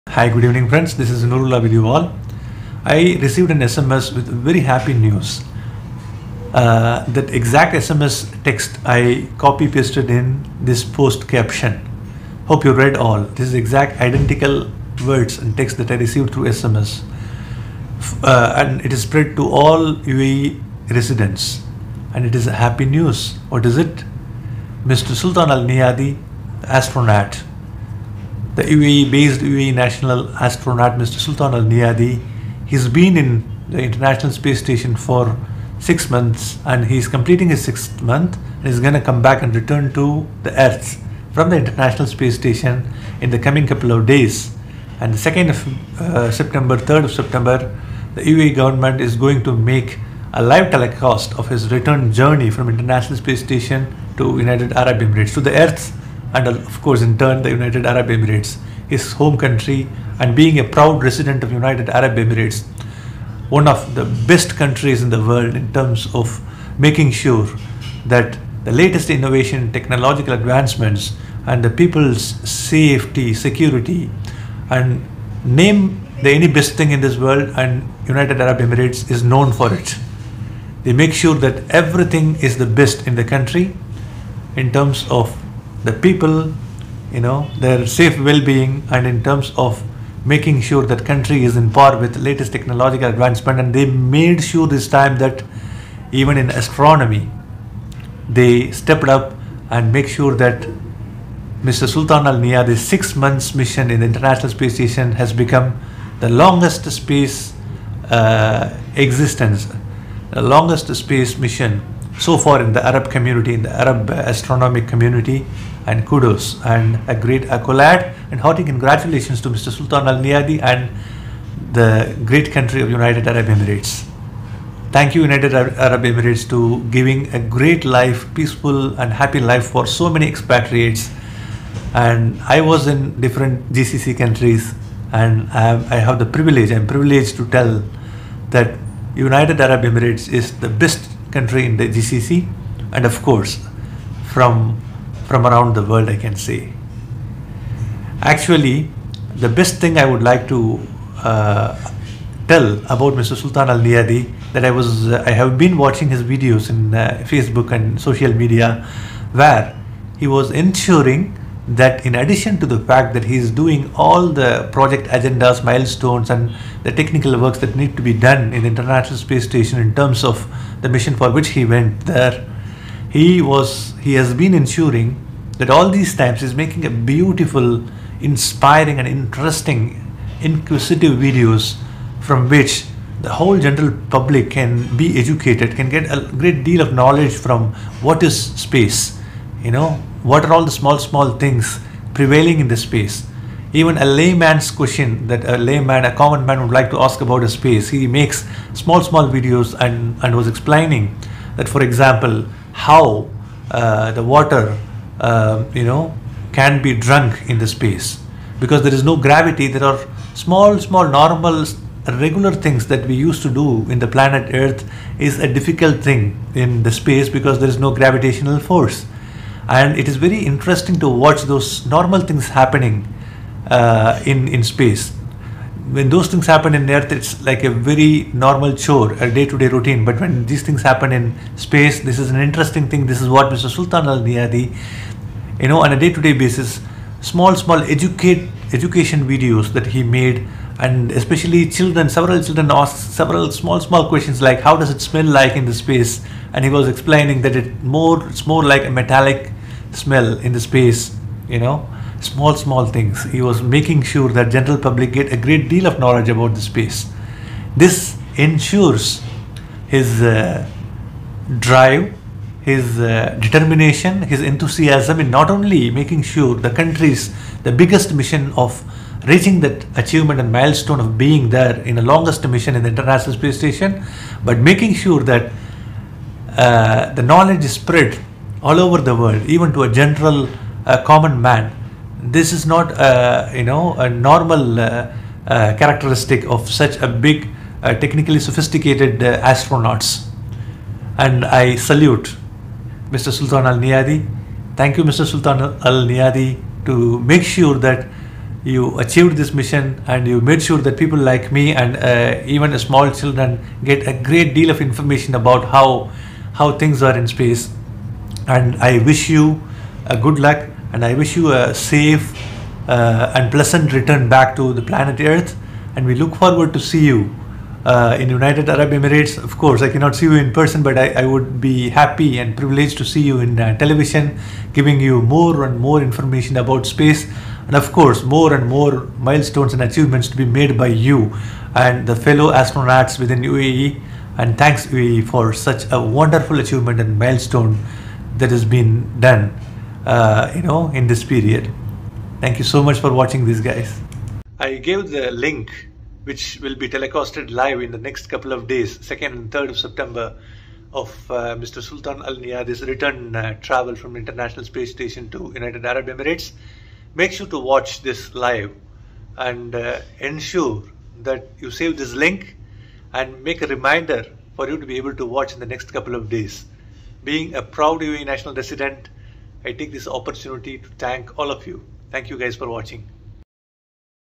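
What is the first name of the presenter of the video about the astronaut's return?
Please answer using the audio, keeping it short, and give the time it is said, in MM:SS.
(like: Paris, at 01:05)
Nurullah, at 00:01.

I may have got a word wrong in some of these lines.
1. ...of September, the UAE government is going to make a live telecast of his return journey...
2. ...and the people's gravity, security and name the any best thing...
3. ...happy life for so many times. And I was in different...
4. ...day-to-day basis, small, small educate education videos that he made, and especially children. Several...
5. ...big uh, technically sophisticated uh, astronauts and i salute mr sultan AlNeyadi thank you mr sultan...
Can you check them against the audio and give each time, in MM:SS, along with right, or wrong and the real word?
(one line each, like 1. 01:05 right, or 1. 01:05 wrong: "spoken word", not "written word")
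1. 00:47 right
2. 01:11 wrong: "safety", not "gravity"
3. 02:09 wrong: "expatriates", not "times"
4. 03:55 right
5. 04:47 right.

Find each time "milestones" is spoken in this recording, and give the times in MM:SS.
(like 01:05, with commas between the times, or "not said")
02:45, 04:30, 05:29, 05:37.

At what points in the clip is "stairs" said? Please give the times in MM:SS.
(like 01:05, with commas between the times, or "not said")
not said.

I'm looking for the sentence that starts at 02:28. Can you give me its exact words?
Actually, the best thing I would like to uh, tell about Mr.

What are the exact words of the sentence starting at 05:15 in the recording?
And we look forward to see you uh, in United Arab Emirates.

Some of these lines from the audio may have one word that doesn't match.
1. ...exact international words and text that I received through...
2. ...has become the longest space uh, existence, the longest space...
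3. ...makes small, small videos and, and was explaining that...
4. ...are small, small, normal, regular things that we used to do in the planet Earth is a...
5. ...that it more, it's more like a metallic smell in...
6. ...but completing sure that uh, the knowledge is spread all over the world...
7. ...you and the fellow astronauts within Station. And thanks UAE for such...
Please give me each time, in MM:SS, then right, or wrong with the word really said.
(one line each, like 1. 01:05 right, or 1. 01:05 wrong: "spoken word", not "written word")
1. 00:13 wrong: "identical", not "international"
2. 01:45 right
3. 03:18 right
4. 03:29 right
5. 04:07 right
6. 04:34 wrong: "making", not "completing"
7. 05:30 wrong: "UAE", not "Station".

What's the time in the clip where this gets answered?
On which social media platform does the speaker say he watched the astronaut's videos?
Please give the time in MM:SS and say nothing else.
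02:37.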